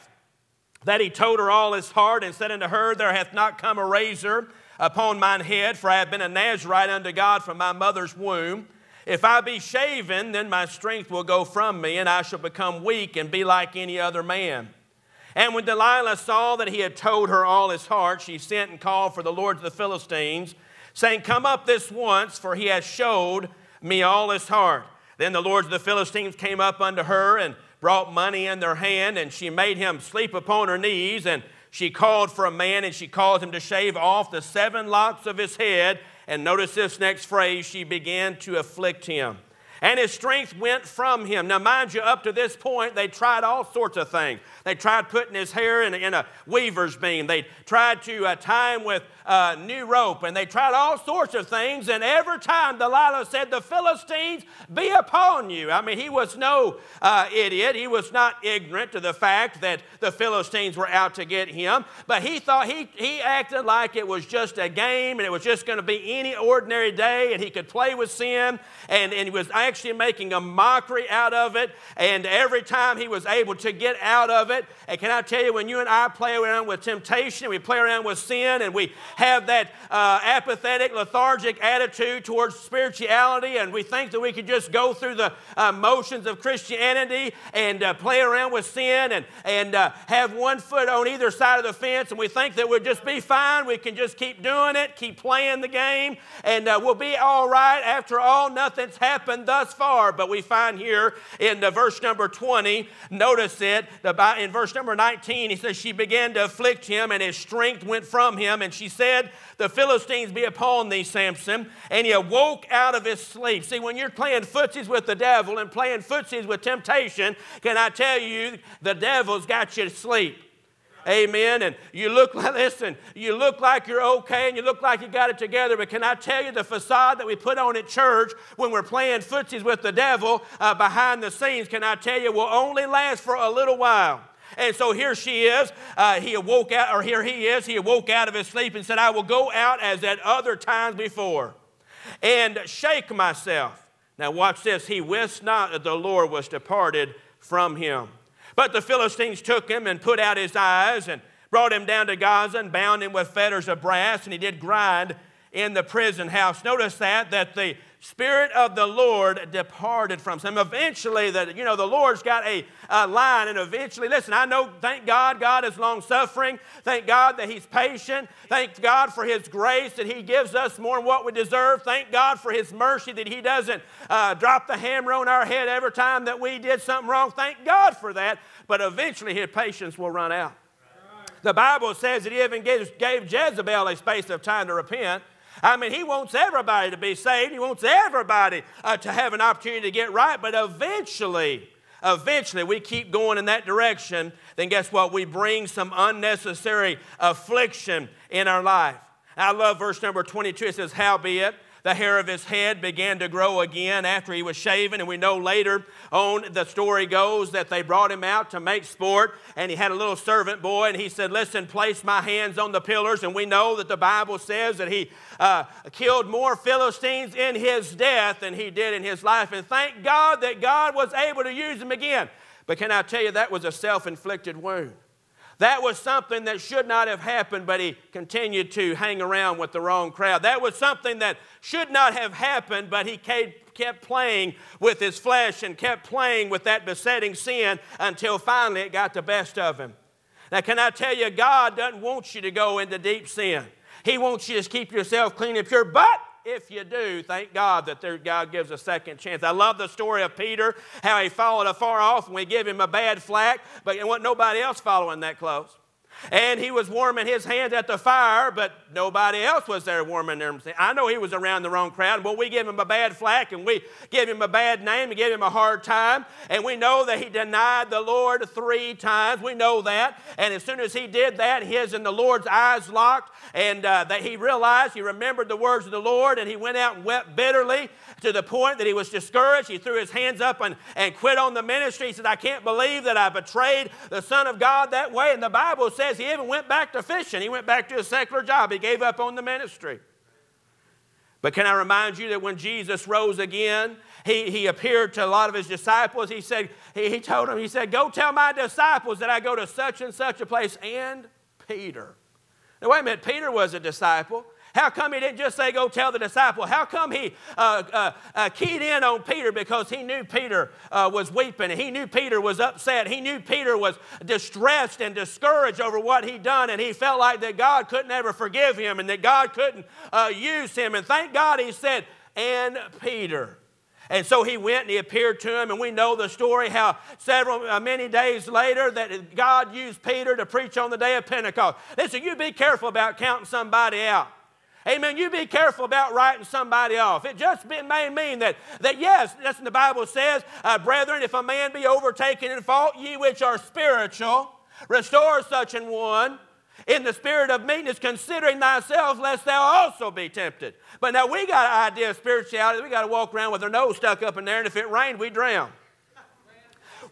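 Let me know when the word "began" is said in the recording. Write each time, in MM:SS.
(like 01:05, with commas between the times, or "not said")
00:37, 01:45, 03:22.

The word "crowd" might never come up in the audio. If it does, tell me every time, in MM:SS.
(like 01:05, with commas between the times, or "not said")
03:50, 04:21.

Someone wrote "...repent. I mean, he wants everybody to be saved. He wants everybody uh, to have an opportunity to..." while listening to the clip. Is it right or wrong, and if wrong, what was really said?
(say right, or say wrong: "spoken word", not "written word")
right.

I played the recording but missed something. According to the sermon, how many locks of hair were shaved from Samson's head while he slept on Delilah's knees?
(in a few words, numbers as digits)
7.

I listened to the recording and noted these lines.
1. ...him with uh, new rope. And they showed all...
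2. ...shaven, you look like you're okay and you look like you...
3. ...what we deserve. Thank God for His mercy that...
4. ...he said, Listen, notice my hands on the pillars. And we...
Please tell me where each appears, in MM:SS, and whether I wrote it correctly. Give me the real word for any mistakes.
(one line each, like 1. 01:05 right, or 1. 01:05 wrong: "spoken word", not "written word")
1. 00:48 wrong: "tried", not "showed"
2. 02:02 wrong: "listen", not "shaven"
3. 02:51 right
4. 03:30 wrong: "place", not "notice".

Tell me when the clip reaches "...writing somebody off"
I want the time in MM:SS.
05:36.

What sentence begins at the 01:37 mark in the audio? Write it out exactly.
After all, nothing's happened thus far.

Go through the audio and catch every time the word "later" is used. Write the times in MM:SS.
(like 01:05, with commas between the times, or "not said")
03:25, 05:28.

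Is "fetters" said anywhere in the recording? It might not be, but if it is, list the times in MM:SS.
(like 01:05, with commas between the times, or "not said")
02:33.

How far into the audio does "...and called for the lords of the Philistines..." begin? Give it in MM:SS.
00:18.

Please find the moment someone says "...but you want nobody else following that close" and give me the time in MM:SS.
04:13.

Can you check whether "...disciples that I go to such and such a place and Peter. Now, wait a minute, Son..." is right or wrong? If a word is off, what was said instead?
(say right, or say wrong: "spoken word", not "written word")
wrong: "Peter", not "Son".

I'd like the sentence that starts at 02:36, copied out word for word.
Notice that, that the Spirit of the Lord departed from him.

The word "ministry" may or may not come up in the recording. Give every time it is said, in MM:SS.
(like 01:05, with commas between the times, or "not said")
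04:41, 04:49.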